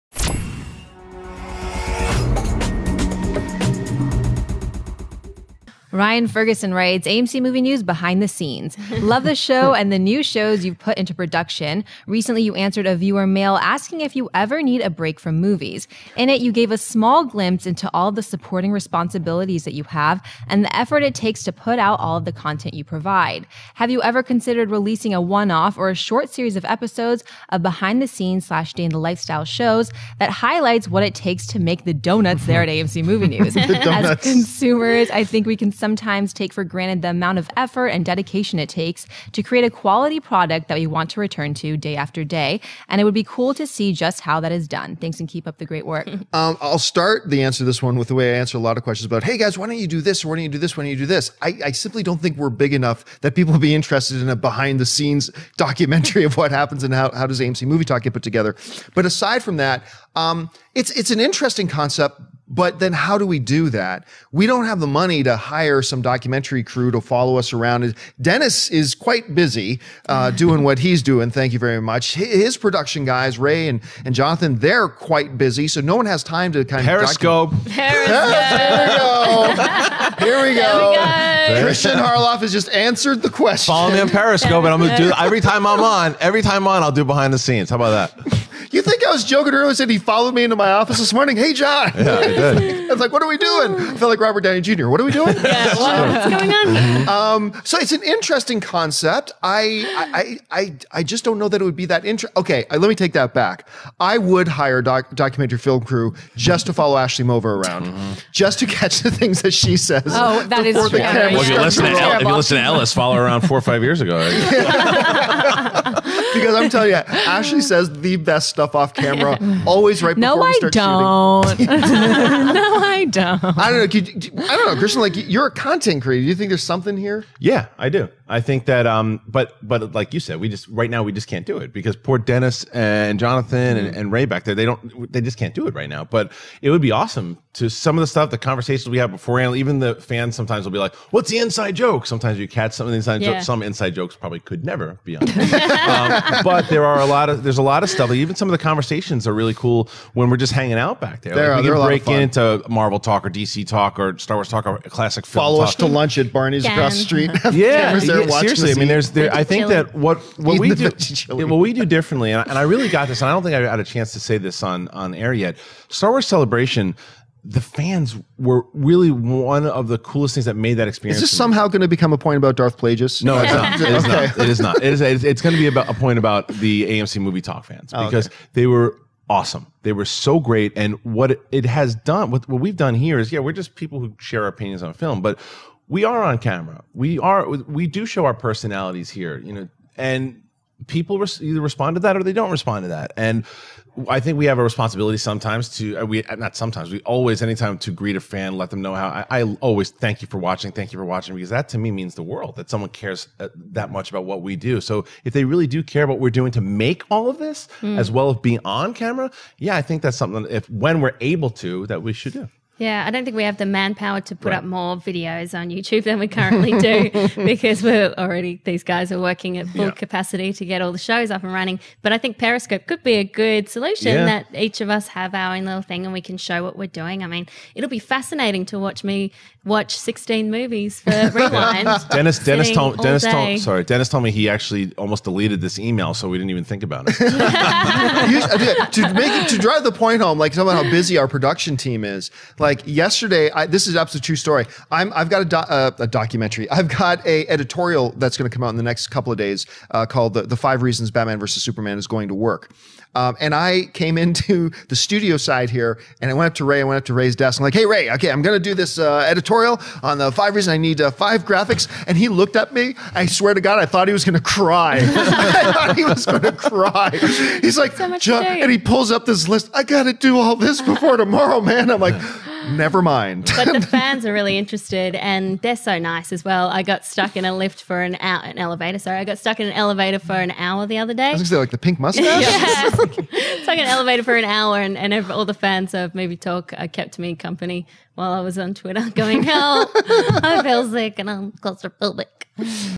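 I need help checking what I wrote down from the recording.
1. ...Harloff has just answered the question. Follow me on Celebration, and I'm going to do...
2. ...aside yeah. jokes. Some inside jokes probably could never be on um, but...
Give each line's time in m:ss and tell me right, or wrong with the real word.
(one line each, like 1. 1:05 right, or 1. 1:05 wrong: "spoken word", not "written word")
1. 1:21 wrong: "Periscope", not "Celebration"
2. 2:22 wrong: "inside", not "aside".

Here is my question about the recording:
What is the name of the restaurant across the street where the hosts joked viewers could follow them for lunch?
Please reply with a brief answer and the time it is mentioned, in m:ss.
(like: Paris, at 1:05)
Barney's, at 2:36.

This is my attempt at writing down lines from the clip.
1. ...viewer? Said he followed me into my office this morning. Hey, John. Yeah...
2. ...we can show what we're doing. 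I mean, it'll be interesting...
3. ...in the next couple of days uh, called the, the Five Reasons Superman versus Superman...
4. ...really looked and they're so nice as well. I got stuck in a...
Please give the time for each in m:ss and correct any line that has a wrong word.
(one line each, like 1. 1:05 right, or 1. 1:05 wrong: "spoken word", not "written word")
1. 1:29 wrong: "earlier", not "viewer"
2. 3:46 wrong: "fascinating", not "interesting"
3. 4:08 wrong: "Batman", not "Superman"
4. 4:34 wrong: "interested", not "looked".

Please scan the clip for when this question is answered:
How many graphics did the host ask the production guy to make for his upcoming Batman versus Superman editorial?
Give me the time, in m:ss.
4:21.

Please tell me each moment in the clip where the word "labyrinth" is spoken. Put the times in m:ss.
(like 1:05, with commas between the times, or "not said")
not said.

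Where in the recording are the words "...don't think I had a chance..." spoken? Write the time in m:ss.
2:43.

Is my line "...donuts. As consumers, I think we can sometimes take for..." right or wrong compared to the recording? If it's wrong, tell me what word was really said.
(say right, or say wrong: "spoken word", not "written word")
right.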